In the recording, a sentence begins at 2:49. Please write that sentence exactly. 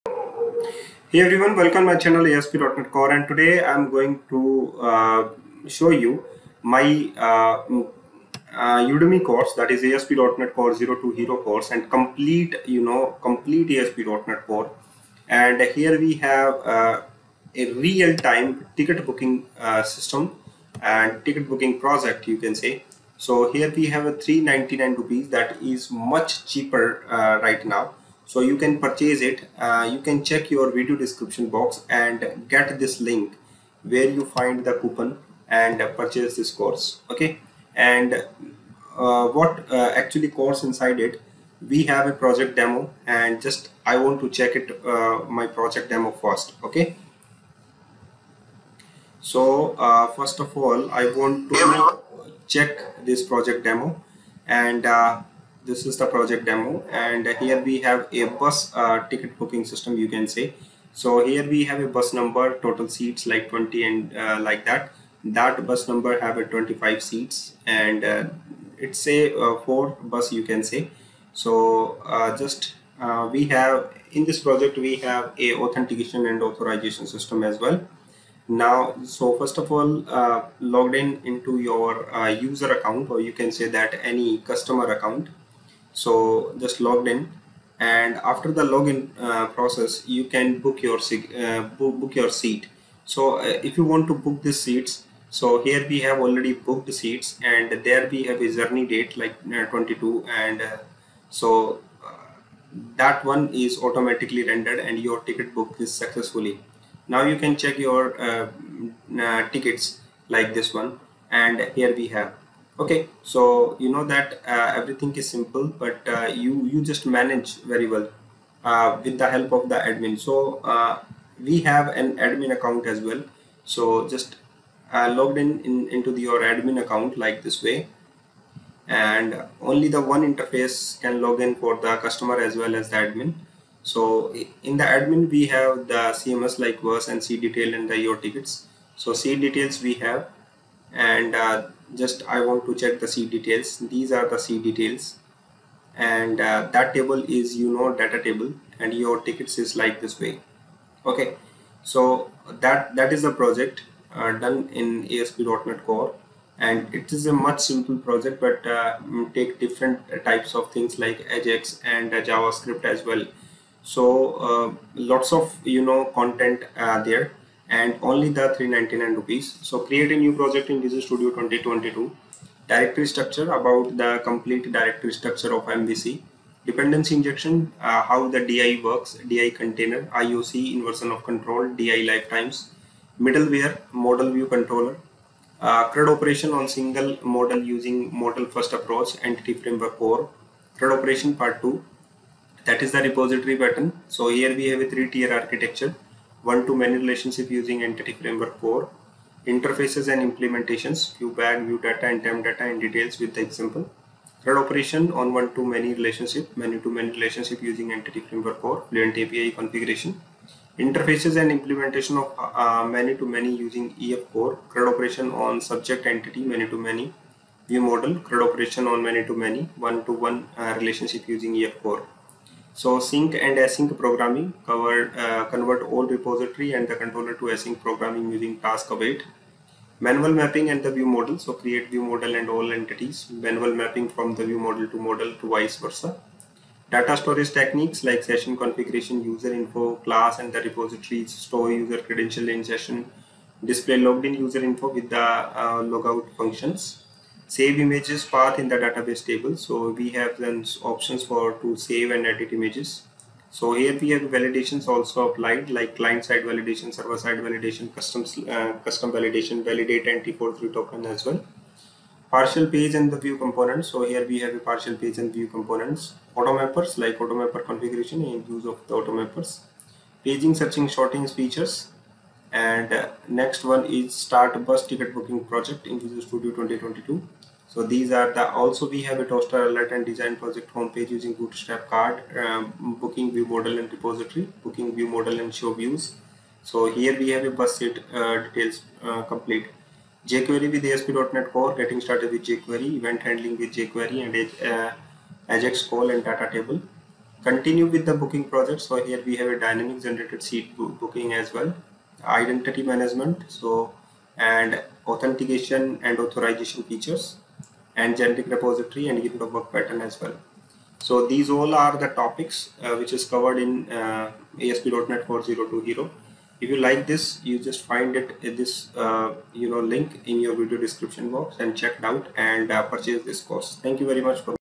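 So create a new project in Visual Studio 2022.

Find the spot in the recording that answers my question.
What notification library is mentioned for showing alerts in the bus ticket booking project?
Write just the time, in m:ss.
4:39.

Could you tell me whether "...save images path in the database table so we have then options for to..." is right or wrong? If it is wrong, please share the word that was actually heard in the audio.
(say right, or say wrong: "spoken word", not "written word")
right.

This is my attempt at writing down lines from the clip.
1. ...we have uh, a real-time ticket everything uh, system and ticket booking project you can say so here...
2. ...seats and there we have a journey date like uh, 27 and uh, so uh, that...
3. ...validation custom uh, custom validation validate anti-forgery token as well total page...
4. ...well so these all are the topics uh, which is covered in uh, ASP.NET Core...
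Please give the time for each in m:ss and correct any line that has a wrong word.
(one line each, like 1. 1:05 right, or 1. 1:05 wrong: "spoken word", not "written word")
1. 0:15 wrong: "booking", not "everything"
2. 1:36 wrong: "22", not "27"
3. 4:17 wrong: "partial", not "total"
4. 5:10 right.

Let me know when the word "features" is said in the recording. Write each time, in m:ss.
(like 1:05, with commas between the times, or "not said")
4:31, 5:06.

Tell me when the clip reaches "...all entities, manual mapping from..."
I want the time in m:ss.
3:52.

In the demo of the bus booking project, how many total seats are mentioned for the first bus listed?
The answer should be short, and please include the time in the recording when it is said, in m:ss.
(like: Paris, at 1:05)
20, at 1:03.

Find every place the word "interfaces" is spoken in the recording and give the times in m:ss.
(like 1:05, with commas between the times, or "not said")
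2:10, 3:19, 3:30.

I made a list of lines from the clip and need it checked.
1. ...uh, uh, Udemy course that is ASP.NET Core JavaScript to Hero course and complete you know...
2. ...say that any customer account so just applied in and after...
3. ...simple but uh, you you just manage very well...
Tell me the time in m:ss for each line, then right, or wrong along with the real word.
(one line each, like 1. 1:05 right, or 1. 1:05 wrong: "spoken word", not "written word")
1. 0:07 wrong: "Zero", not "JavaScript"
2. 1:23 wrong: "logged", not "applied"
3. 1:55 right.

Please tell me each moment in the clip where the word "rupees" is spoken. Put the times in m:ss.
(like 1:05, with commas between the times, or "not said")
0:24, 2:49.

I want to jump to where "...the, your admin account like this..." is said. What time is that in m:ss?
2:06.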